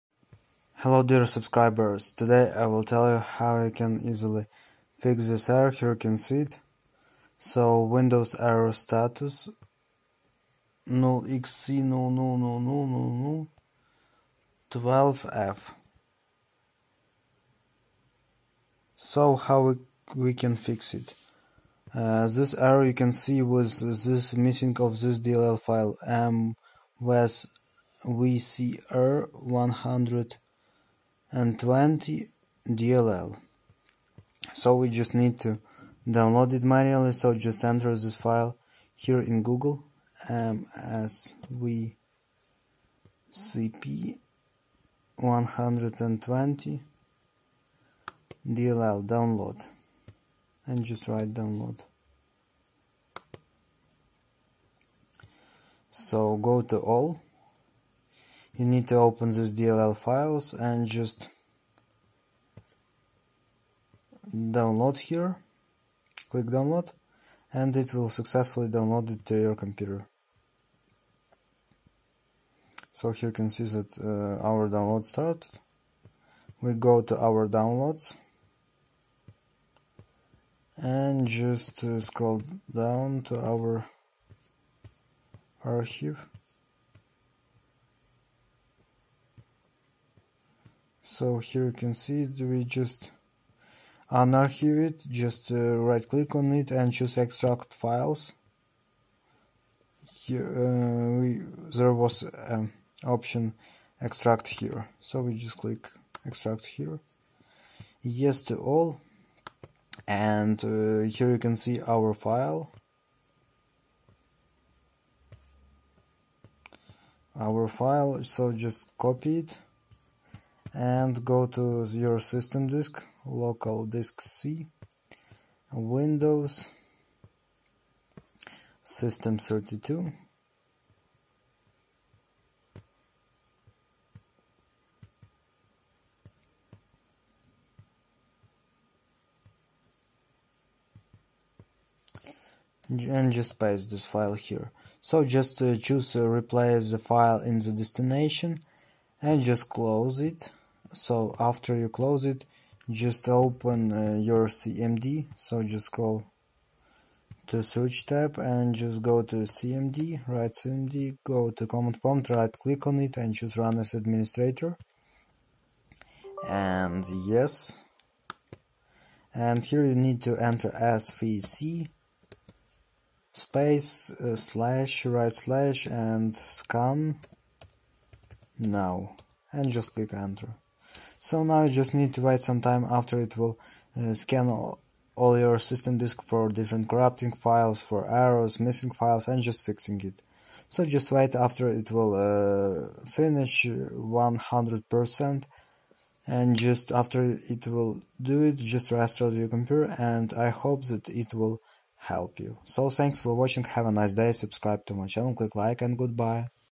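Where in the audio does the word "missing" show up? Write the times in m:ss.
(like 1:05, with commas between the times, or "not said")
0:24, 3:08.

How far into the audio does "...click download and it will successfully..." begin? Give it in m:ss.
1:06.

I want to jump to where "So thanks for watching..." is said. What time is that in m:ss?
3:22.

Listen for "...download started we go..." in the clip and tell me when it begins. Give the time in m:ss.
1:14.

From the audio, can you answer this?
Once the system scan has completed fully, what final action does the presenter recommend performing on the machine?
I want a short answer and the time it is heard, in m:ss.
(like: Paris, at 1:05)
restart your computer, at 3:18.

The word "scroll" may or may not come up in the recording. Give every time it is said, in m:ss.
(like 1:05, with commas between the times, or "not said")
1:21, 2:35.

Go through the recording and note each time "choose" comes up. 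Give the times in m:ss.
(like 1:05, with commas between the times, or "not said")
1:36, 2:25, 2:43.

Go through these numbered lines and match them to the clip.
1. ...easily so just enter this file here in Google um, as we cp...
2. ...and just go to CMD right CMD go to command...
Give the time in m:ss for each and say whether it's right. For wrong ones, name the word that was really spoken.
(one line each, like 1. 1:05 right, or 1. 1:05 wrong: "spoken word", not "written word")
1. 0:36 wrong: "manually", not "easily"
2. 2:38 right.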